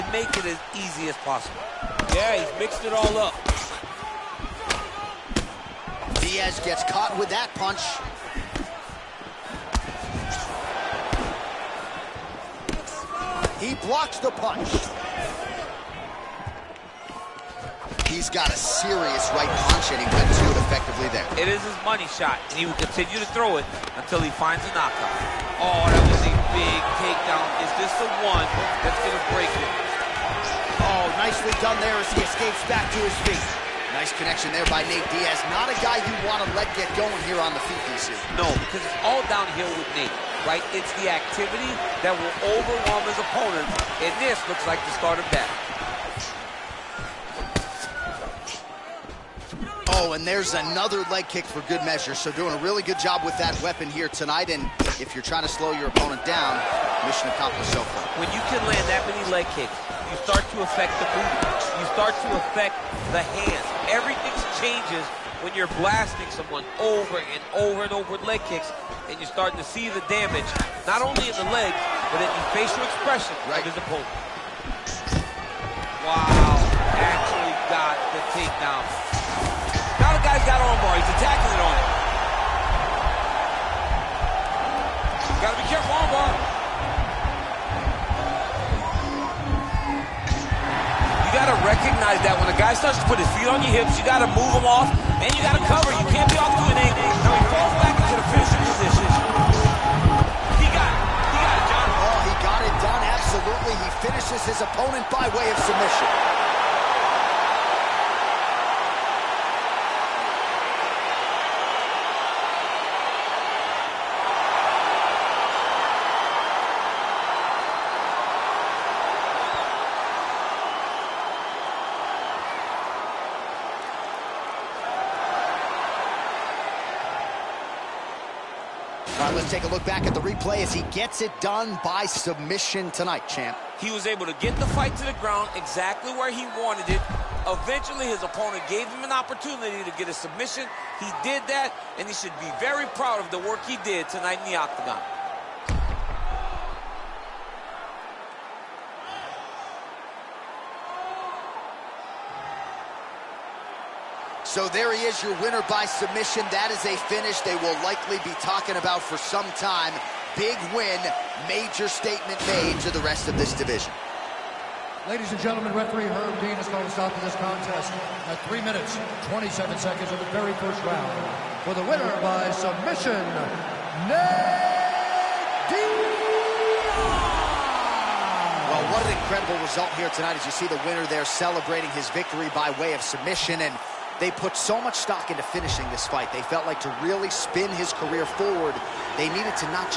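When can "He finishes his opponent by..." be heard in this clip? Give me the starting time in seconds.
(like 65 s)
103 s.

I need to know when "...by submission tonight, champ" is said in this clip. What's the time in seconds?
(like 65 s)
131 s.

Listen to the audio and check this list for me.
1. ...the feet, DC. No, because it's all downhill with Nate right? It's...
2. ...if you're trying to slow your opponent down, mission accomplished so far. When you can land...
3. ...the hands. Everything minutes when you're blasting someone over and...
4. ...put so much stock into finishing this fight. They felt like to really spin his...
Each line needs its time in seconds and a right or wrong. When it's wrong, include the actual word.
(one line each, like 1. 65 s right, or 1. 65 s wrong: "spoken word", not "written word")
1. 37 s right
2. 55 s right
3. 63 s wrong: "changes", not "minutes"
4. 184 s right.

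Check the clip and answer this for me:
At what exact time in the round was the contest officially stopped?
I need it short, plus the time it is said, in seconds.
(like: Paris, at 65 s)
3 minutes, 27 seconds, at 168 s.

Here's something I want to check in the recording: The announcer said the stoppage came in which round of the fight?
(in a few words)
First.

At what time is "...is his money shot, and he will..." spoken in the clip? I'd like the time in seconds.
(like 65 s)
21 s.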